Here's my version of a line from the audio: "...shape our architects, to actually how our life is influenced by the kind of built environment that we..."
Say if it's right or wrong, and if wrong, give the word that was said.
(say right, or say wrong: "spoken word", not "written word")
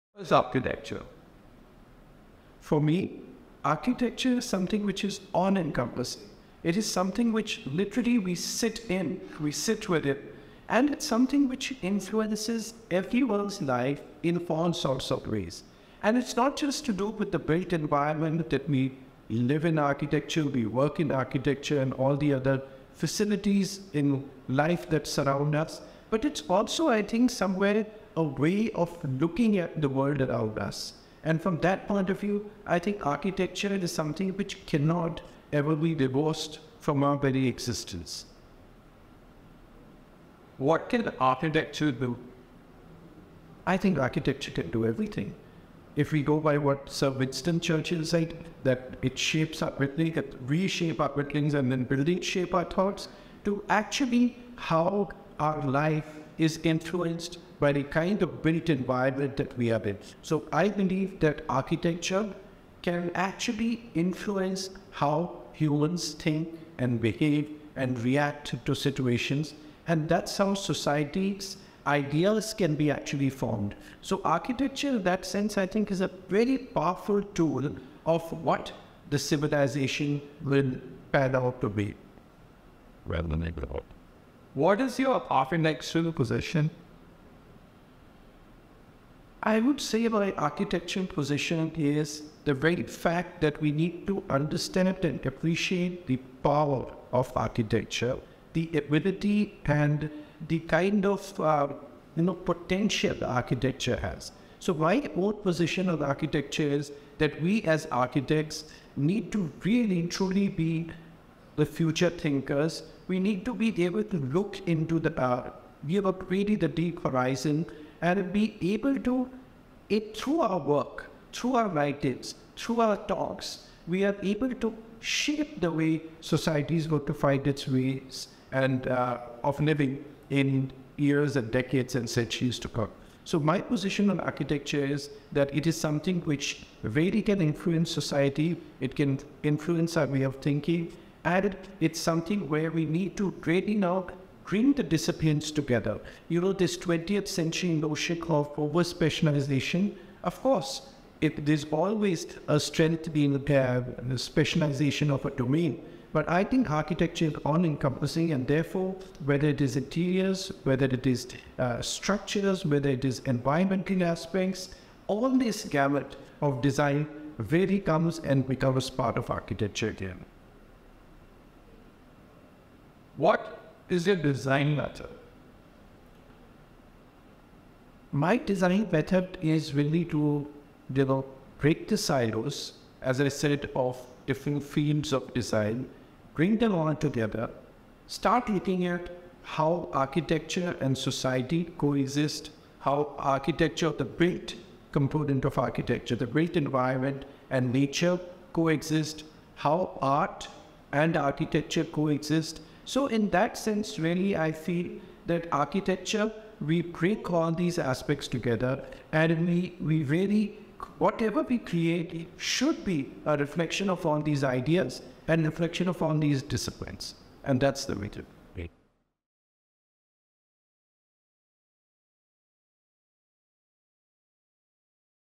wrong: "thoughts", not "architects".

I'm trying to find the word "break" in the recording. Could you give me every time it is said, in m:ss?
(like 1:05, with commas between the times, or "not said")
3:01, 3:26.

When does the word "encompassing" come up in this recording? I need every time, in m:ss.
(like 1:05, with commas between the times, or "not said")
0:05, 2:37.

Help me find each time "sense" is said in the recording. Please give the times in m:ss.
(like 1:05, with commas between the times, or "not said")
1:15, 3:23.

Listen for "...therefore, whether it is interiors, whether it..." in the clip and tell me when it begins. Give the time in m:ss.
2:38.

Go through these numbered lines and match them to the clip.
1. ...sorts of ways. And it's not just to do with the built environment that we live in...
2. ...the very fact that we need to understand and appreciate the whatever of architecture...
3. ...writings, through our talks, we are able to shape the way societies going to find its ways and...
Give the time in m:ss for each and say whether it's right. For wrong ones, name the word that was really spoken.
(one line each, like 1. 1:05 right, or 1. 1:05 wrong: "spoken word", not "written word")
1. 0:14 right
2. 1:32 wrong: "power", not "whatever"
3. 2:01 right.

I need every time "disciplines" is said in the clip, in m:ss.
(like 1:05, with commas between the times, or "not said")
2:24, 3:36.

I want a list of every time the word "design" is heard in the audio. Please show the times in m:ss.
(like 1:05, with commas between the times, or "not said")
2:46, 2:54, 2:58, 3:05.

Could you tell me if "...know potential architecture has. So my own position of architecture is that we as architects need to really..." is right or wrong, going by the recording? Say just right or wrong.
right.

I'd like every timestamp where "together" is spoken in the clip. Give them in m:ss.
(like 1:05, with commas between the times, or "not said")
2:25, 3:06, 3:28.